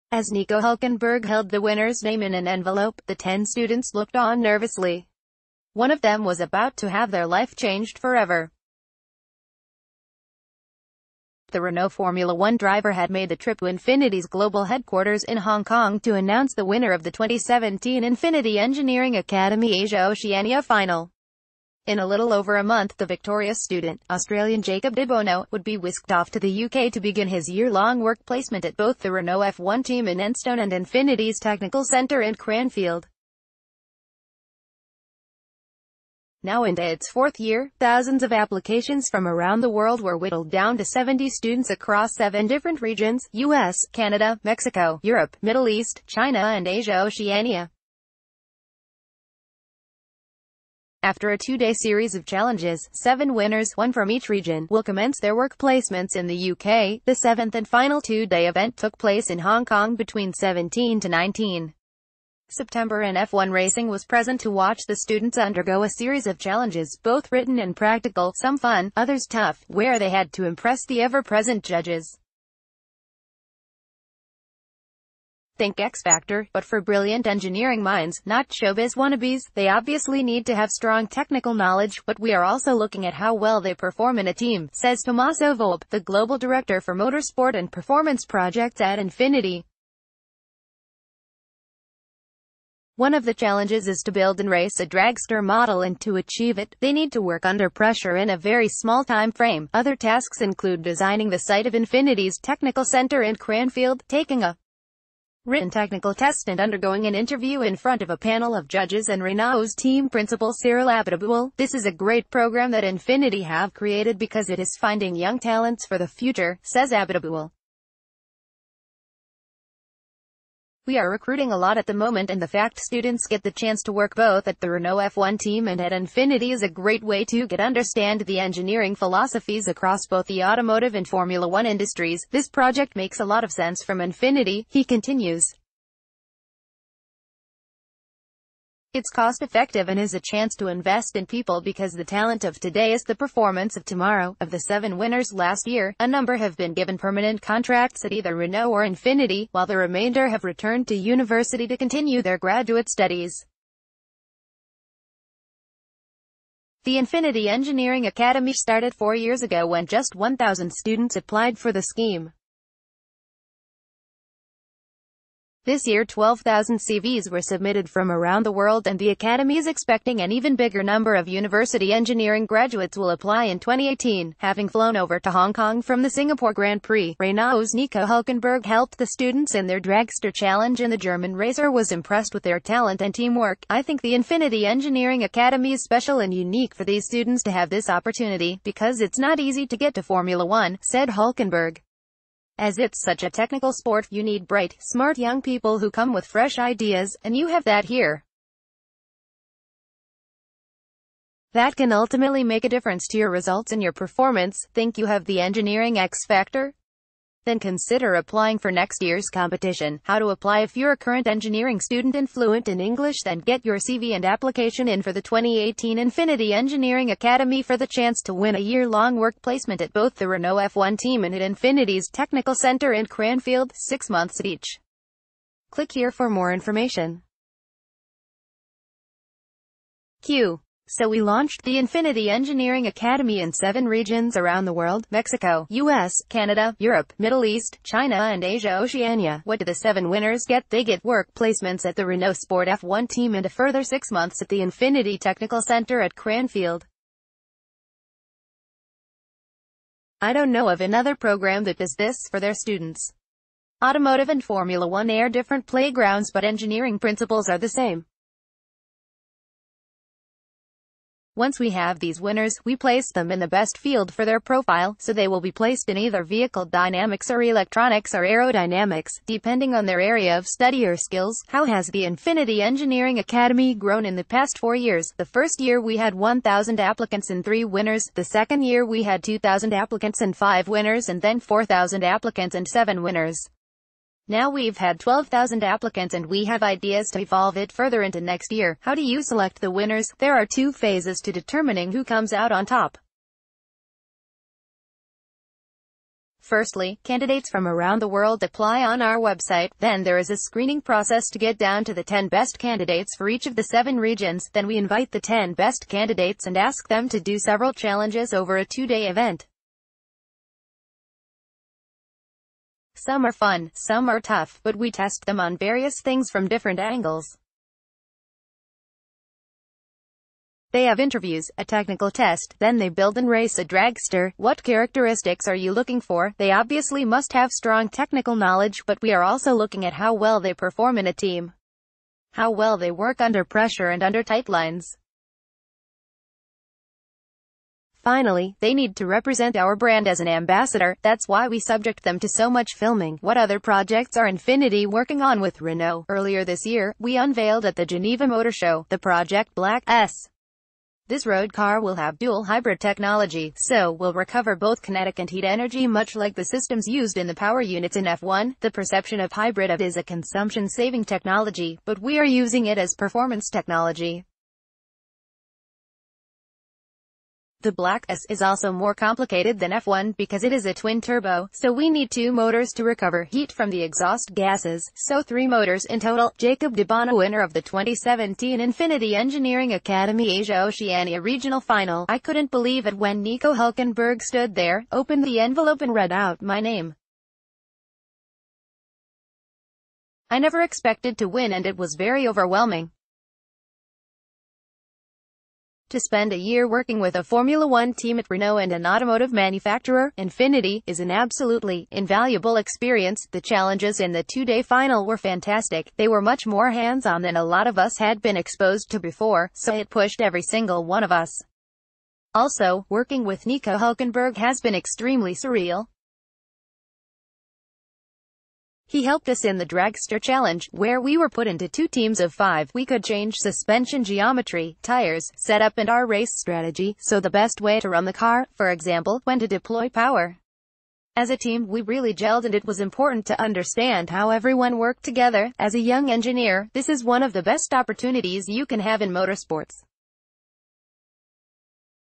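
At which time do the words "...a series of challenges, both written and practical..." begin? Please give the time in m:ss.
1:05.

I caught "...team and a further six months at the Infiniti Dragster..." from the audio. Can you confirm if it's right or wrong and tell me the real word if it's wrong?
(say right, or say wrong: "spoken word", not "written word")
wrong: "Technical", not "Dragster".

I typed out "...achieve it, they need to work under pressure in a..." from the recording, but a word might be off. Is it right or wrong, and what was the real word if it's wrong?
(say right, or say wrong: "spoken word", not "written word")
right.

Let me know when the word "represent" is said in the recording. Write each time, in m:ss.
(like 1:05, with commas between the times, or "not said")
5:39.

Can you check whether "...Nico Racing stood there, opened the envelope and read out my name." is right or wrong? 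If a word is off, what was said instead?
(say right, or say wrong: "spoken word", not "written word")
wrong: "Hulkenberg", not "Racing".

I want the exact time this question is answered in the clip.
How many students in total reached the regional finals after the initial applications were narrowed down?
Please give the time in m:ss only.
0:40.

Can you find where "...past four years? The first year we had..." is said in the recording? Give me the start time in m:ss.
4:34.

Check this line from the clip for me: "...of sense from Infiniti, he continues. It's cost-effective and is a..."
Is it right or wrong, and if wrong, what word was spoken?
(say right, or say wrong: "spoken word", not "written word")
right.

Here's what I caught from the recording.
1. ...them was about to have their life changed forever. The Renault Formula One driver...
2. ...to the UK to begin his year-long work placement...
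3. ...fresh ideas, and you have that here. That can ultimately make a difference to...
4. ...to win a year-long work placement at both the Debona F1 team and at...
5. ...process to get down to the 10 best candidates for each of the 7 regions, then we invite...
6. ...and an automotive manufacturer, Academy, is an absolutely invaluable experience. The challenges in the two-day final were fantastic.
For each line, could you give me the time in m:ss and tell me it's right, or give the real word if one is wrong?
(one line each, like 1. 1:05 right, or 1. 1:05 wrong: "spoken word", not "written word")
1. 0:06 right
2. 0:26 right
3. 3:16 right
4. 3:38 wrong: "Renault", not "Debona"
5. 5:00 right
6. 6:38 wrong: "Infiniti", not "Academy".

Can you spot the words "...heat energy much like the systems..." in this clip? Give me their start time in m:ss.
5:55.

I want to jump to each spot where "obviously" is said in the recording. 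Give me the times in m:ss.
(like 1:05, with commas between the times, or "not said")
1:19, 5:26.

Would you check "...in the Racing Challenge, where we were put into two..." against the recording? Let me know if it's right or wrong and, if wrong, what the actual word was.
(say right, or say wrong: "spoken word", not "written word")
wrong: "Dragster", not "Racing".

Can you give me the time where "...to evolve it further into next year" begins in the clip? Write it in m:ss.
4:47.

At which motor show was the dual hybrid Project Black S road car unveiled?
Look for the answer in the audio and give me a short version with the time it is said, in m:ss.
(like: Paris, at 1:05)
Geneva Motor Show, at 5:47.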